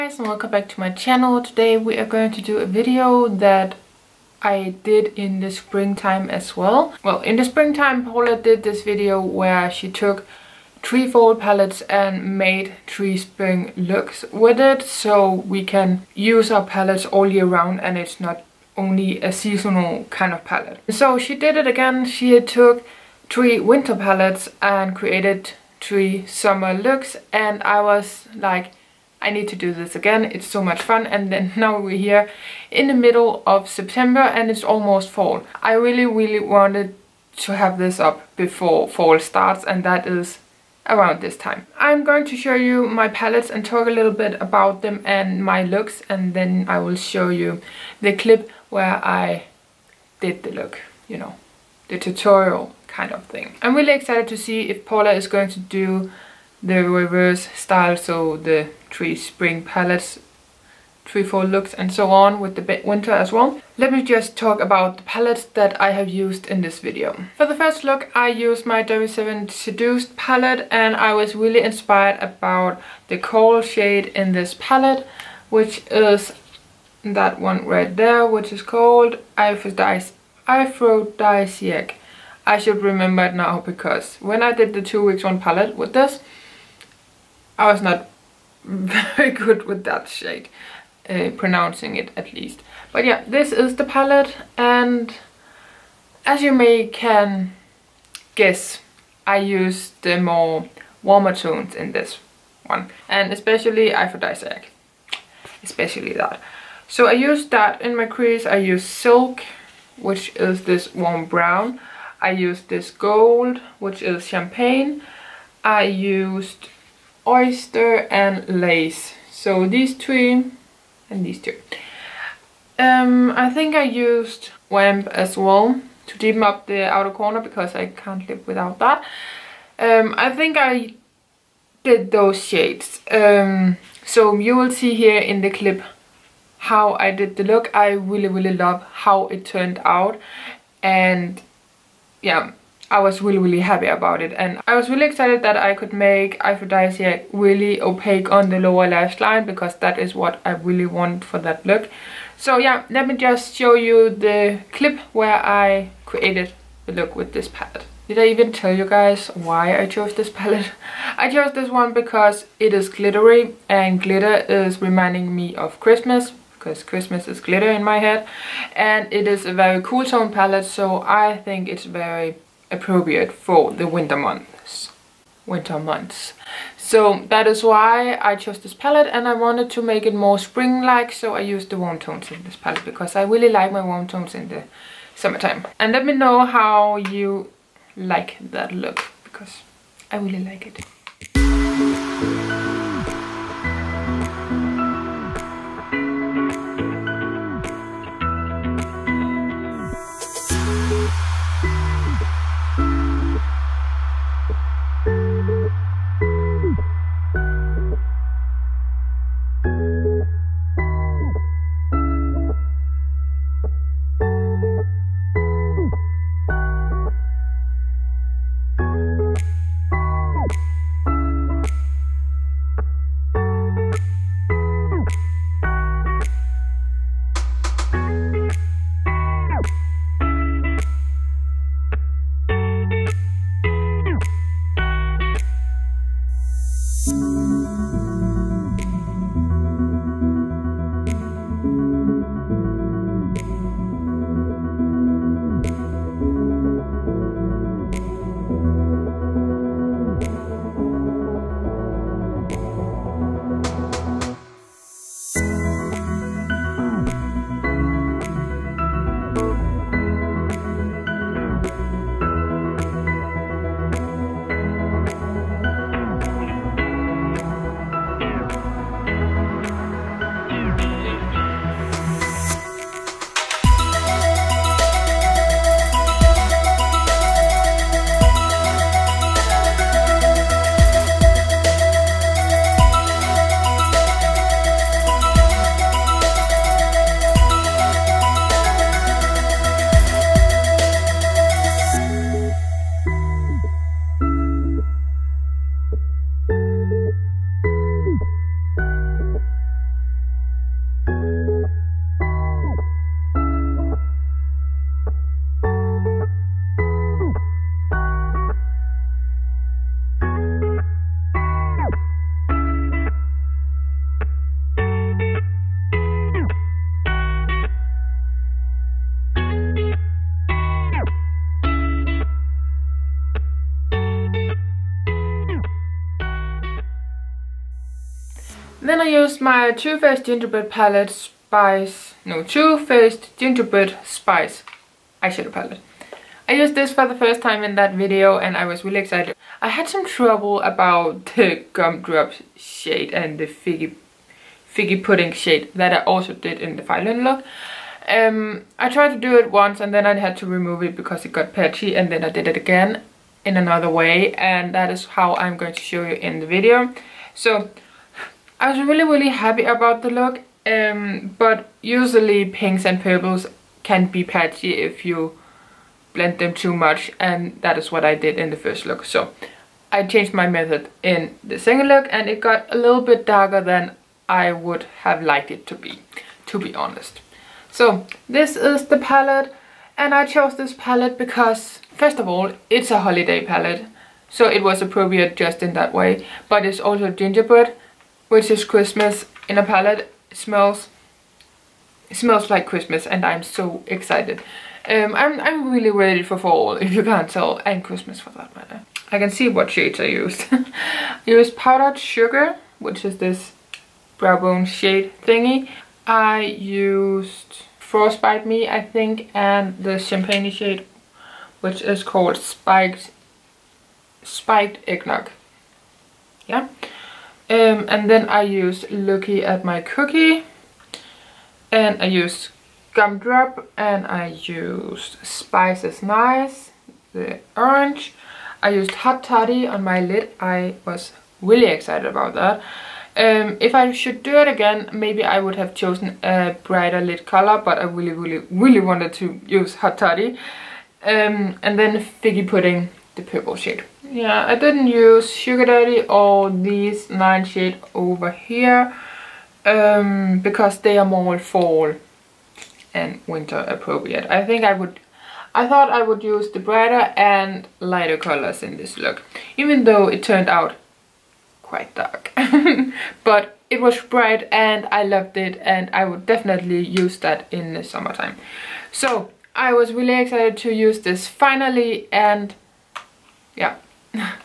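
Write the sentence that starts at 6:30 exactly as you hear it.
It smells it smells like Christmas and I'm so excited.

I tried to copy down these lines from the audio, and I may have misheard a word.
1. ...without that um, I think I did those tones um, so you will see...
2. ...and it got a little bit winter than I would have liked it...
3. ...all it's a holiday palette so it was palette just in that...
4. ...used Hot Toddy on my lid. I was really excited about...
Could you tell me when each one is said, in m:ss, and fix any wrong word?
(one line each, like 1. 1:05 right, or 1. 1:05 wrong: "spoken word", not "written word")
1. 2:08 wrong: "shades", not "tones"
2. 6:12 wrong: "darker", not "winter"
3. 6:22 wrong: "appropriate", not "palette"
4. 7:08 right.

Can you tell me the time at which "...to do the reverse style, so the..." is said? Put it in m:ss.
0:55.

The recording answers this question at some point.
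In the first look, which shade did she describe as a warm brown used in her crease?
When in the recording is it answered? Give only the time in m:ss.
1:48.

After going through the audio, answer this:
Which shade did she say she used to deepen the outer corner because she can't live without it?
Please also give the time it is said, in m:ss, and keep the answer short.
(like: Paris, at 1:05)
Wamp, at 2:04.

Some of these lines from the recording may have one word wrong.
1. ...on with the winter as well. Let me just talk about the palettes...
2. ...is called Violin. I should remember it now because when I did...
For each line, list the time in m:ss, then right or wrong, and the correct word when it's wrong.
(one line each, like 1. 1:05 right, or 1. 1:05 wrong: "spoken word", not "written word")
1. 1:02 right
2. 1:18 wrong: "Aphrodisiac", not "Violin".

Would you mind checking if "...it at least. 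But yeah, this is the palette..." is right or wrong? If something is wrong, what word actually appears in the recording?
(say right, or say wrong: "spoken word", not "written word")
right.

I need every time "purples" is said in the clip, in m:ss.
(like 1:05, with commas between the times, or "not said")
6:03, 7:23.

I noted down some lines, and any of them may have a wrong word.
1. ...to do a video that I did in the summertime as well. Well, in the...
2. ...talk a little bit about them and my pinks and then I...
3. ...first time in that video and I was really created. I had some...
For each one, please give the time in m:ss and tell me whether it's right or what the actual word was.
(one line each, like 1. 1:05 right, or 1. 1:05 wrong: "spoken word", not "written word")
1. 0:02 wrong: "springtime", not "summertime"
2. 0:43 wrong: "looks", not "pinks"
3. 5:37 wrong: "excited", not "created".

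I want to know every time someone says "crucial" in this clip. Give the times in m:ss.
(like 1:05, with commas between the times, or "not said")
not said.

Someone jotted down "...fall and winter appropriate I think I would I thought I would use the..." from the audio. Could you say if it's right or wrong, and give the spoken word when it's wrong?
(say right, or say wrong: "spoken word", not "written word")
right.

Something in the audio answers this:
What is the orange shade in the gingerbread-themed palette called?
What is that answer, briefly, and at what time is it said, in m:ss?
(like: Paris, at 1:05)
Spices Nice, at 7:05.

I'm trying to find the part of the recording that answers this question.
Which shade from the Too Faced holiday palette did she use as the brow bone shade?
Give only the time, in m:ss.
6:41.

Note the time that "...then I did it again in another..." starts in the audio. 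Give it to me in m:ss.
5:52.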